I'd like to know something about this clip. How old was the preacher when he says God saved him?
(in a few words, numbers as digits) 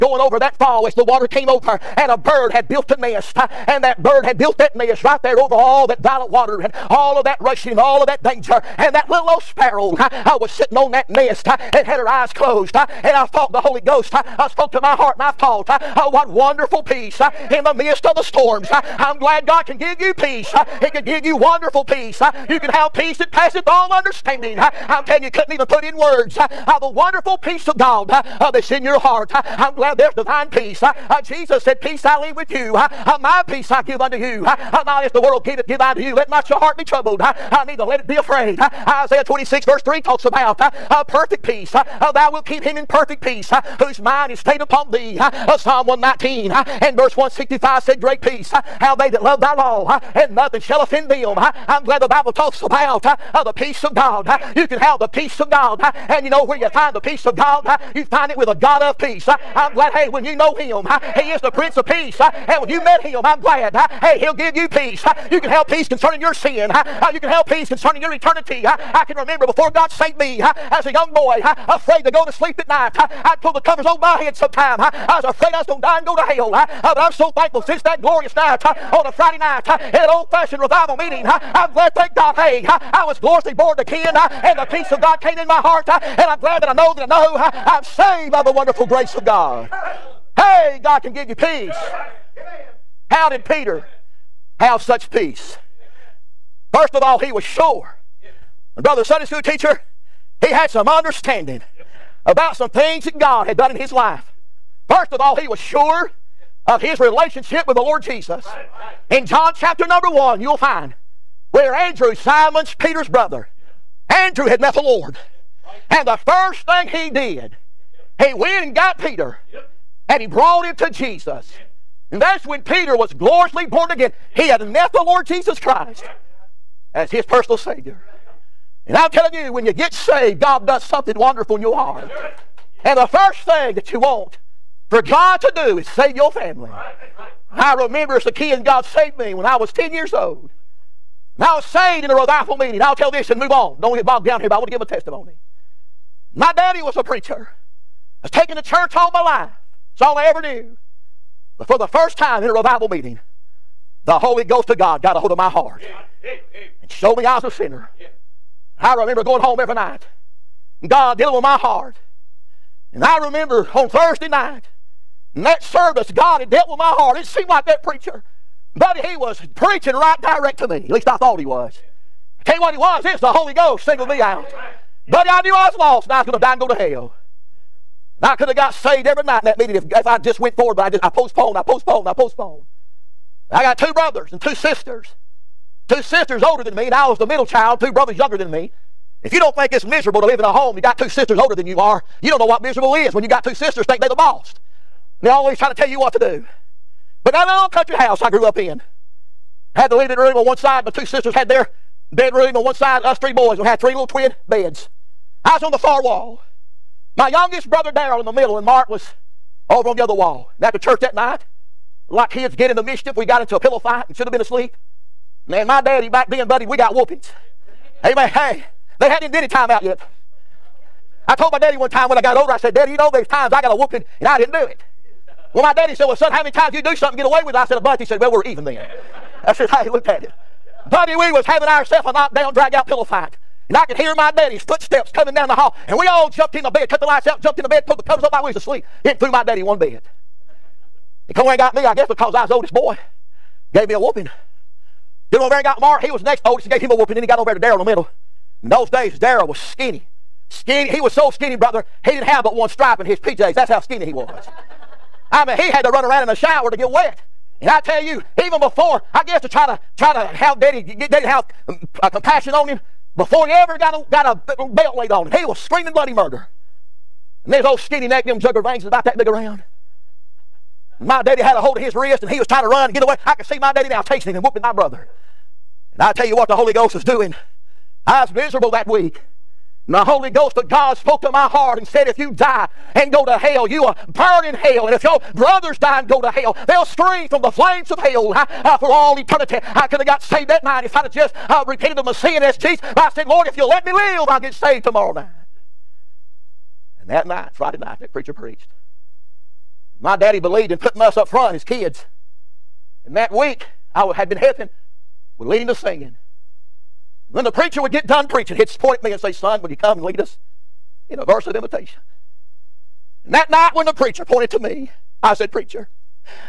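10.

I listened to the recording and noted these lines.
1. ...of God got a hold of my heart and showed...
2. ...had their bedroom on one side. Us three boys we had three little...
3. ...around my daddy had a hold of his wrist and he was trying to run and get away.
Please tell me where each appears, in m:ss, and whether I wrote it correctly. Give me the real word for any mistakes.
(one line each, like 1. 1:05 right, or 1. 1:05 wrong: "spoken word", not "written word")
1. 2:34 right
2. 3:21 right
3. 4:29 right.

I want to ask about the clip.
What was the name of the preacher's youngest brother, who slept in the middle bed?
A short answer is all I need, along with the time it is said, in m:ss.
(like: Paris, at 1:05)
Darrell, at 3:27.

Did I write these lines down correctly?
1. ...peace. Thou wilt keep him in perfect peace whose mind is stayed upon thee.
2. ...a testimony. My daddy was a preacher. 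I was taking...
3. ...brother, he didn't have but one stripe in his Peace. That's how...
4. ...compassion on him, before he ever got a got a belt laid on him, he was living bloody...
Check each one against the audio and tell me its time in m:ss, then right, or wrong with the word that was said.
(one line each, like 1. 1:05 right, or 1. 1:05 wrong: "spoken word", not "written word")
1. 0:41 right
2. 2:24 right
3. 4:11 wrong: "PJs", not "Peace"
4. 4:22 wrong: "screaming", not "living".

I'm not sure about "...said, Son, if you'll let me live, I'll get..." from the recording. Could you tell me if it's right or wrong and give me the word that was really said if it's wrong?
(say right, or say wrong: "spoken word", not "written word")
wrong: "Lord", not "Son".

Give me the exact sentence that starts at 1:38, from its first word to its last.
And brother, the Sunday school teacher, he had some understanding about some things that God had done in his life.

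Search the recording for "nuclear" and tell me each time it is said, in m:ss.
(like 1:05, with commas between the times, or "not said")
not said.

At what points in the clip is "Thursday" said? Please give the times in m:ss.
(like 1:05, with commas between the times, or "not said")
2:43.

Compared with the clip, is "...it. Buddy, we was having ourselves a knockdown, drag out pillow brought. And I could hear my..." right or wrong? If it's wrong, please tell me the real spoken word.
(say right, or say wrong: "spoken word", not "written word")
wrong: "fight", not "brought".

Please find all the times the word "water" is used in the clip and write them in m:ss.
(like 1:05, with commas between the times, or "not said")
0:01, 0:06.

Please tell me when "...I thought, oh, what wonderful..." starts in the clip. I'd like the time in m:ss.
0:15.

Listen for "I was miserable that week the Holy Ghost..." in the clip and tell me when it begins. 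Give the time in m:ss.
4:38.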